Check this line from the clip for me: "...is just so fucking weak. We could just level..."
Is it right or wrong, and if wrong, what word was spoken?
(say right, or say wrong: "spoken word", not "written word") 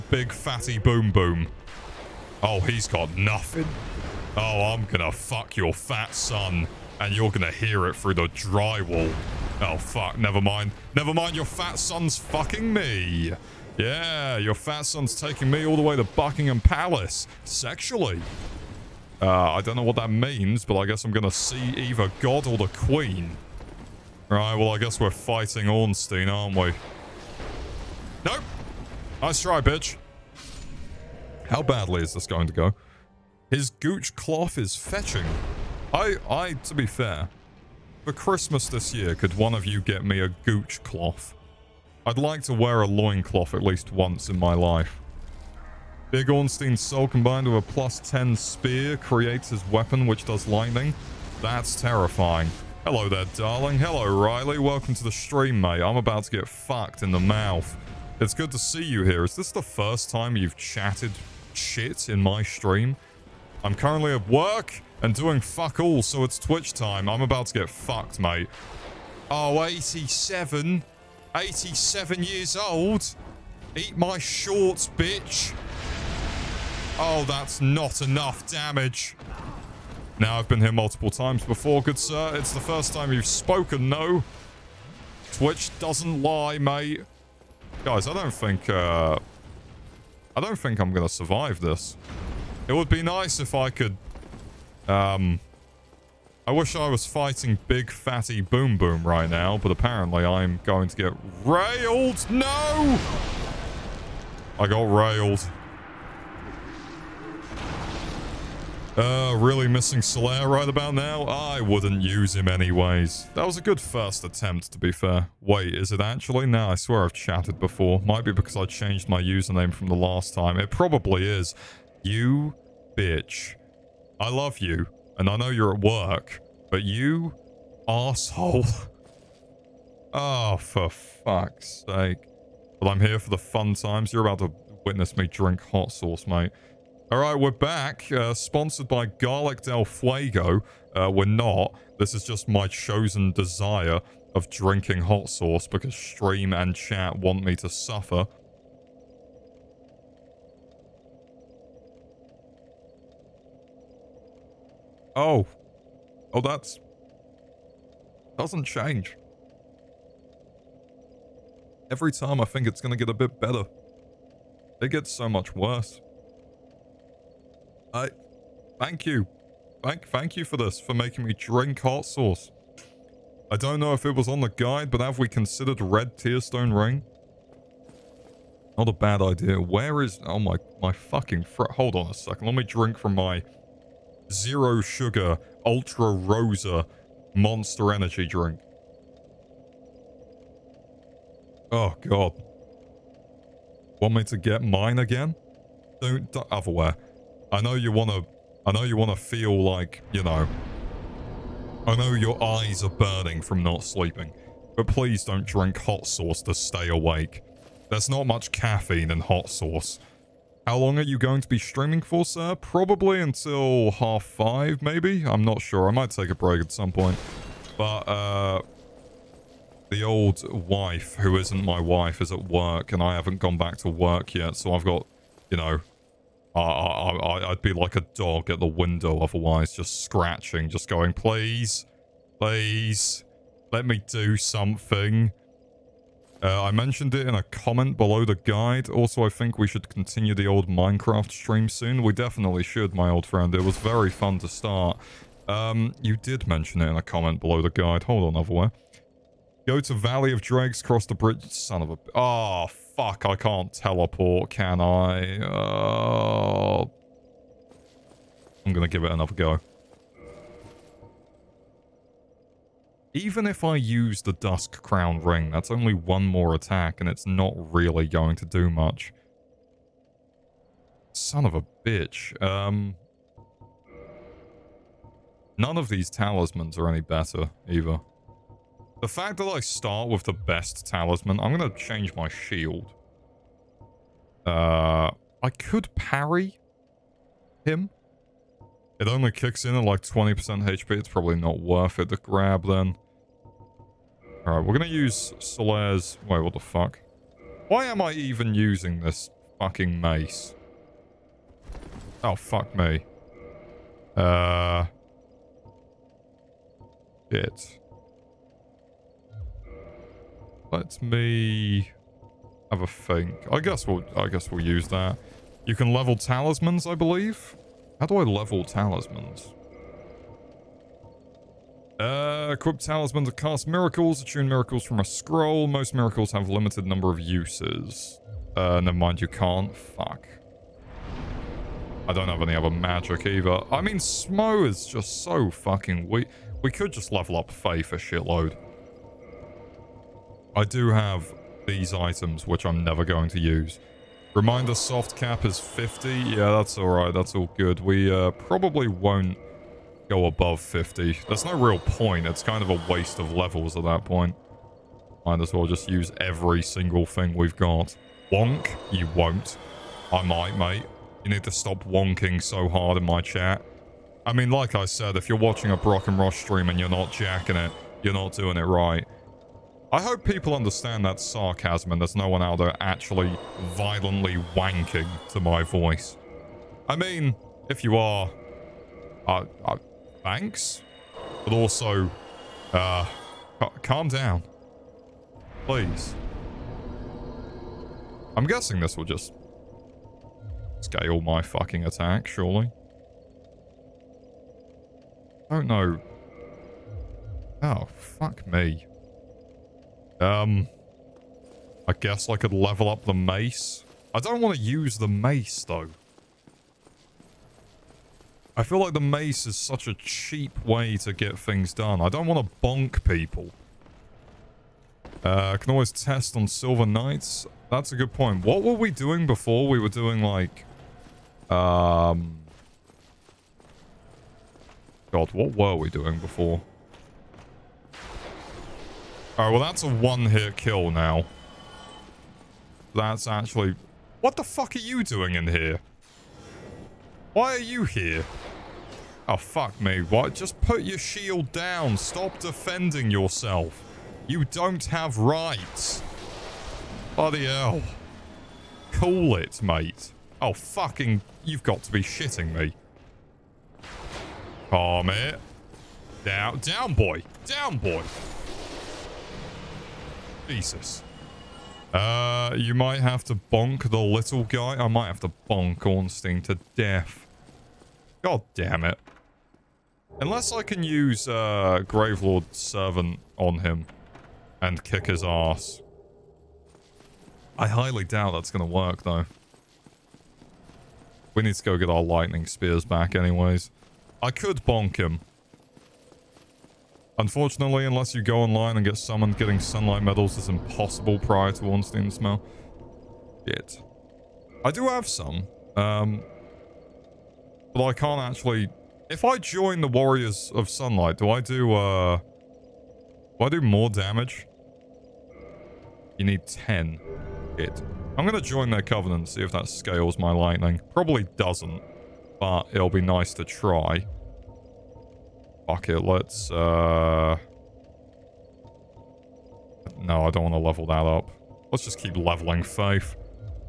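right.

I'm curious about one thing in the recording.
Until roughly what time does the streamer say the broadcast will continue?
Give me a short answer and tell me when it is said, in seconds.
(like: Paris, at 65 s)
Half five, at 213 s.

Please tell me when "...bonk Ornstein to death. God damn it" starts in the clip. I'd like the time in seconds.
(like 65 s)
465 s.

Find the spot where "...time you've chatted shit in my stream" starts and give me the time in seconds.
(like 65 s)
60 s.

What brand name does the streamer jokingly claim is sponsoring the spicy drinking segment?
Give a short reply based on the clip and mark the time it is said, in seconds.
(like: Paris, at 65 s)
Garlic Del Fuego, at 139 s.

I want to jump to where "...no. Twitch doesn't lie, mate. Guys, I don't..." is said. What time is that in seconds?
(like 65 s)
83 s.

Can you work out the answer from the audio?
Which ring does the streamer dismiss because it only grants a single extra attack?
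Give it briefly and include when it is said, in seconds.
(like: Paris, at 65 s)
Dusk Crown Ring, at 264 s.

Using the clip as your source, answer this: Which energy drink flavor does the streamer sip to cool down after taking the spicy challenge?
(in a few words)
Zero sugar Ultra Rosa Monster.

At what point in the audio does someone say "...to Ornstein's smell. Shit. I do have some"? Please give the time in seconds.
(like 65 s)
491 s.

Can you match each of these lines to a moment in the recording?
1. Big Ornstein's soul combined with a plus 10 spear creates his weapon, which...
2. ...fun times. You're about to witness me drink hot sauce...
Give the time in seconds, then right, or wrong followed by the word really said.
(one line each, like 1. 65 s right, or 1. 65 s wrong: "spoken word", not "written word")
1. 46 s right
2. 133 s right.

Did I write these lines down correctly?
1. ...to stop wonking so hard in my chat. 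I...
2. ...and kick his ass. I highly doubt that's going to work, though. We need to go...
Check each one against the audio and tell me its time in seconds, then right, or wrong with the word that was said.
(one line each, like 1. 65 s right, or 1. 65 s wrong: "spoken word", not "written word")
1. 361 s right
2. 474 s right.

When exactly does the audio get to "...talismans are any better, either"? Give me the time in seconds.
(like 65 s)
276 s.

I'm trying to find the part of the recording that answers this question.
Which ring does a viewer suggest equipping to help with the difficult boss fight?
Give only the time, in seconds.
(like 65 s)
175 s.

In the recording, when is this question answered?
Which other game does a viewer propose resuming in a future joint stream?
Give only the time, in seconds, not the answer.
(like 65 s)
240 s.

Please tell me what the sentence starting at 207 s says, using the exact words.
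There's not much caffeine in hot sauce.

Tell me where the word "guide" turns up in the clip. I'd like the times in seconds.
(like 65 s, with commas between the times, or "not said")
174 s, 238 s, 247 s.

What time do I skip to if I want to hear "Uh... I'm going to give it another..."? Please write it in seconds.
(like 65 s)
255 s.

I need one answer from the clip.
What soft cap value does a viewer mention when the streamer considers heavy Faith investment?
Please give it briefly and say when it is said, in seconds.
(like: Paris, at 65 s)
50, at 344 s.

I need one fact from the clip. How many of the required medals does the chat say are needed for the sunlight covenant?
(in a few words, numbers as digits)
10.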